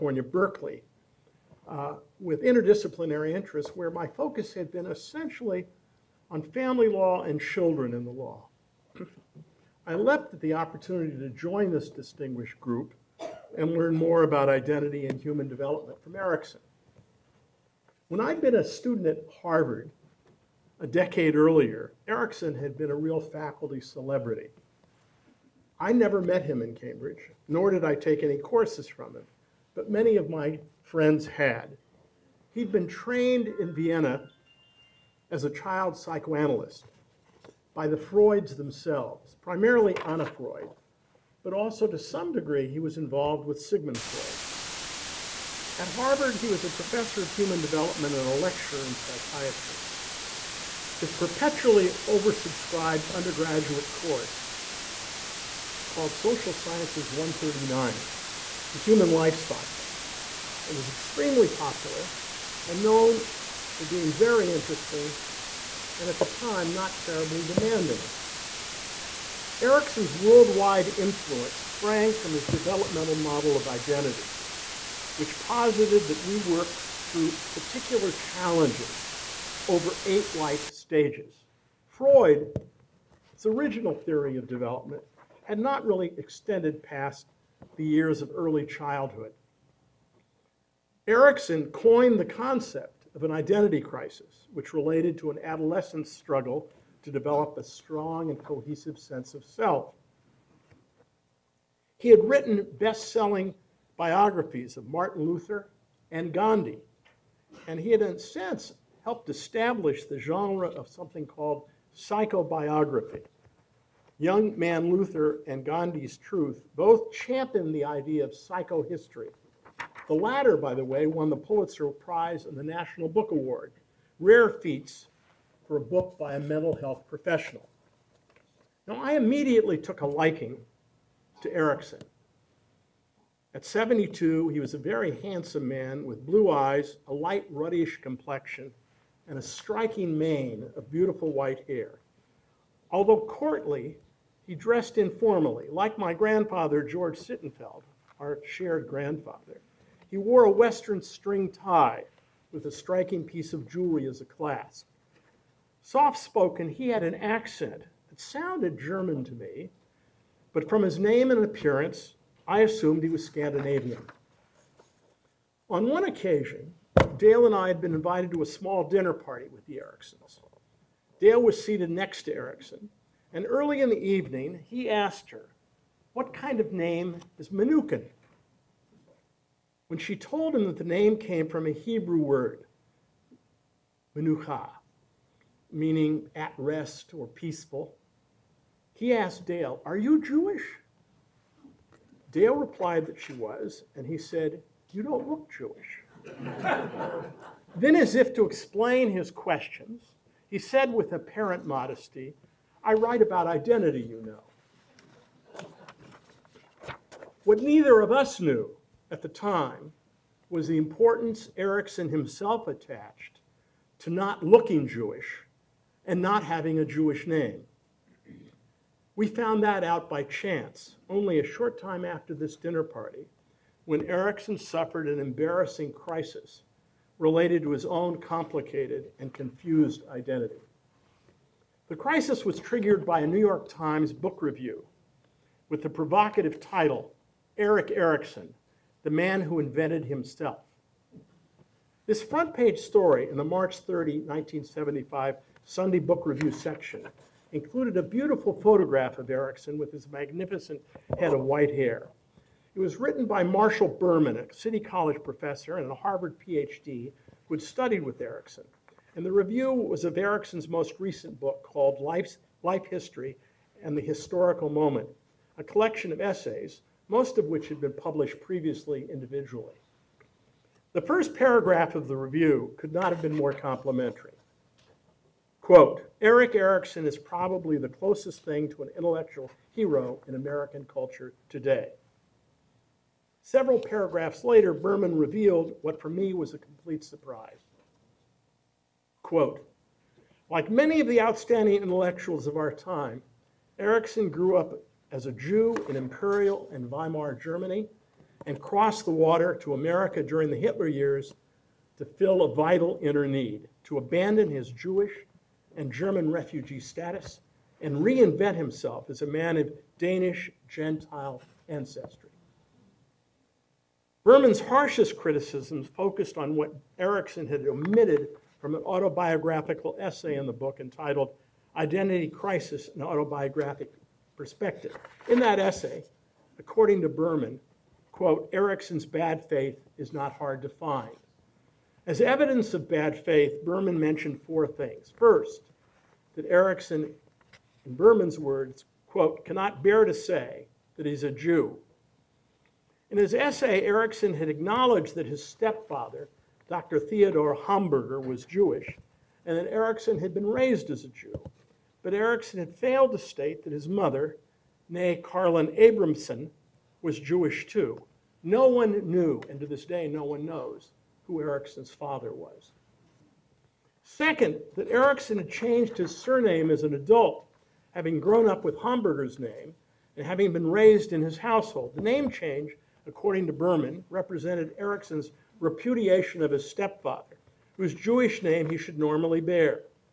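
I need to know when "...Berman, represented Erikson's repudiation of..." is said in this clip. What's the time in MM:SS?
06:13.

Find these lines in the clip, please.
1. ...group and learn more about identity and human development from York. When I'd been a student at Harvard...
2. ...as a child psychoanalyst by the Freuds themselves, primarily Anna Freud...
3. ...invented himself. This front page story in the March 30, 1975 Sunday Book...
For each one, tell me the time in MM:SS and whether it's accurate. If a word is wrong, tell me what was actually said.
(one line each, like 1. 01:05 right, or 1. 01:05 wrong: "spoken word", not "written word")
1. 00:12 wrong: "Erikson", not "York"
2. 00:35 right
3. 03:59 right.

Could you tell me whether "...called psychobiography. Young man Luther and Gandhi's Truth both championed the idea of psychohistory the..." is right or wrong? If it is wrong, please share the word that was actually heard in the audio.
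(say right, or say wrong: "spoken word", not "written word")
right.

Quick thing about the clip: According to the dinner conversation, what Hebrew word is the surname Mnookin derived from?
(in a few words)
menucha.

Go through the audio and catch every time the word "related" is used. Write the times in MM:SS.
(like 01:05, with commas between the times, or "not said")
01:34, 03:47.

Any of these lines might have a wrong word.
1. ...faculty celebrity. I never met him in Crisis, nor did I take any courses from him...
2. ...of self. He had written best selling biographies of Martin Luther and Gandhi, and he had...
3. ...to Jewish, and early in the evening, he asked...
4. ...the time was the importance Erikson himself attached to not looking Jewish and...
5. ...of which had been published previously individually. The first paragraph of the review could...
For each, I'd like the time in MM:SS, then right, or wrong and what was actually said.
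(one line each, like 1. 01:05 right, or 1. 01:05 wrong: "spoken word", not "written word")
1. 00:23 wrong: "Cambridge", not "Crisis"
2. 01:39 right
3. 02:52 wrong: "Erikson", not "Jewish"
4. 03:29 right
5. 04:27 right.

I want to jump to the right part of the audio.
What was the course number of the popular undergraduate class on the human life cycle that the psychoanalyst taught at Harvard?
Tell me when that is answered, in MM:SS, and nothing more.
00:56.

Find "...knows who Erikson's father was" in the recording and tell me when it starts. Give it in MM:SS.
06:00.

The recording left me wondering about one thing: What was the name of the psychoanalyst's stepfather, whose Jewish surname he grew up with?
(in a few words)
Theodore Hamburger.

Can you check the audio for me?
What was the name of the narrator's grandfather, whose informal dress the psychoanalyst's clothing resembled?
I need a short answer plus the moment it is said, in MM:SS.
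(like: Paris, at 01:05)
George Sittenfeld, at 02:26.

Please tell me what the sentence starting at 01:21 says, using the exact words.
Freud's original theory of development had not really extended past the years of early childhood.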